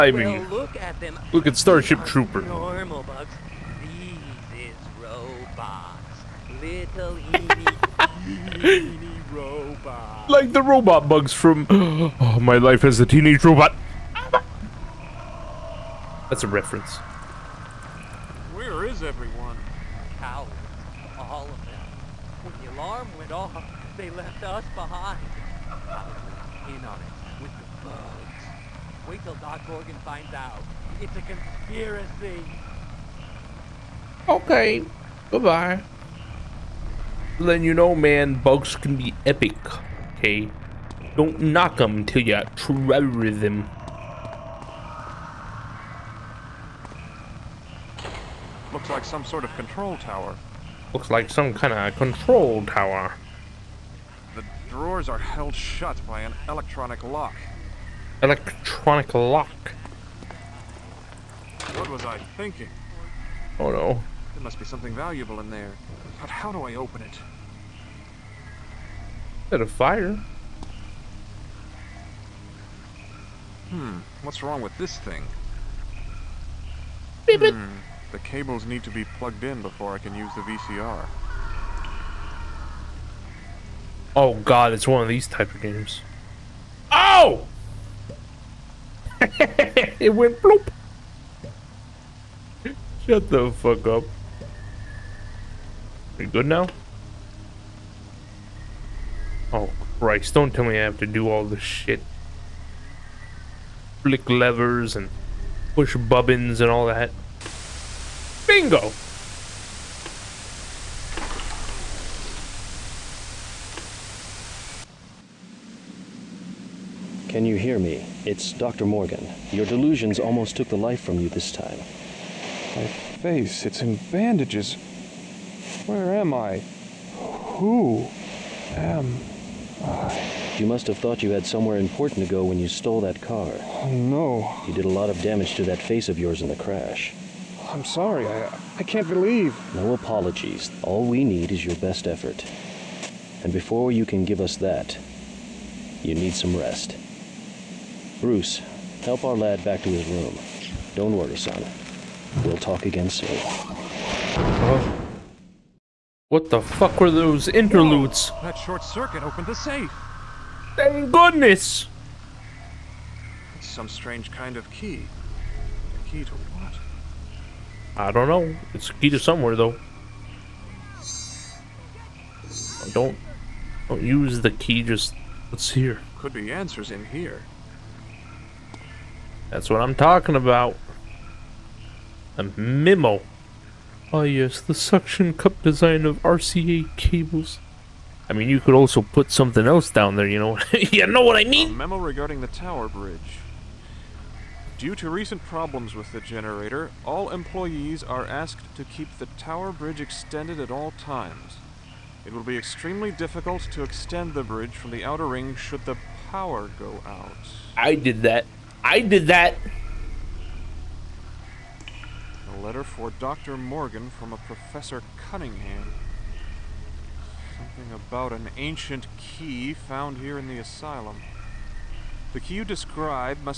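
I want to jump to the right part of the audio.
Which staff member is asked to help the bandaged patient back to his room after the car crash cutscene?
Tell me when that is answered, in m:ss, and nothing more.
2:28.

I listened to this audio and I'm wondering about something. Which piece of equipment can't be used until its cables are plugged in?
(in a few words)
VCR.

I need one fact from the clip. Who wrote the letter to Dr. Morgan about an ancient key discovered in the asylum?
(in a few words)
Professor Cunningham.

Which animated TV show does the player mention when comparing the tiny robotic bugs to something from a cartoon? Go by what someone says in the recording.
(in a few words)
My Life as a Teenage Robot.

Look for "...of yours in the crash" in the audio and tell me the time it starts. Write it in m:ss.
2:16.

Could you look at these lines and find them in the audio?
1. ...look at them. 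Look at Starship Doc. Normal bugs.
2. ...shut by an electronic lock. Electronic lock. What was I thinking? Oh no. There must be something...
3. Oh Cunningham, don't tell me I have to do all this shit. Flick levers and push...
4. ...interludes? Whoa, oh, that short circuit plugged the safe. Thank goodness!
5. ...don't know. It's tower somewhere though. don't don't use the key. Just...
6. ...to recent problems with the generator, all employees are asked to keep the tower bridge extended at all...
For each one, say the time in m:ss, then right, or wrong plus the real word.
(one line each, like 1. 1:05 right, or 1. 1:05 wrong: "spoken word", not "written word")
1. 0:00 wrong: "Trooper", not "Doc"
2. 0:55 right
3. 1:39 wrong: "Christ", not "Cunningham"
4. 2:37 wrong: "opened", not "plugged"
5. 2:48 wrong: "either", not "tower"
6. 3:14 right.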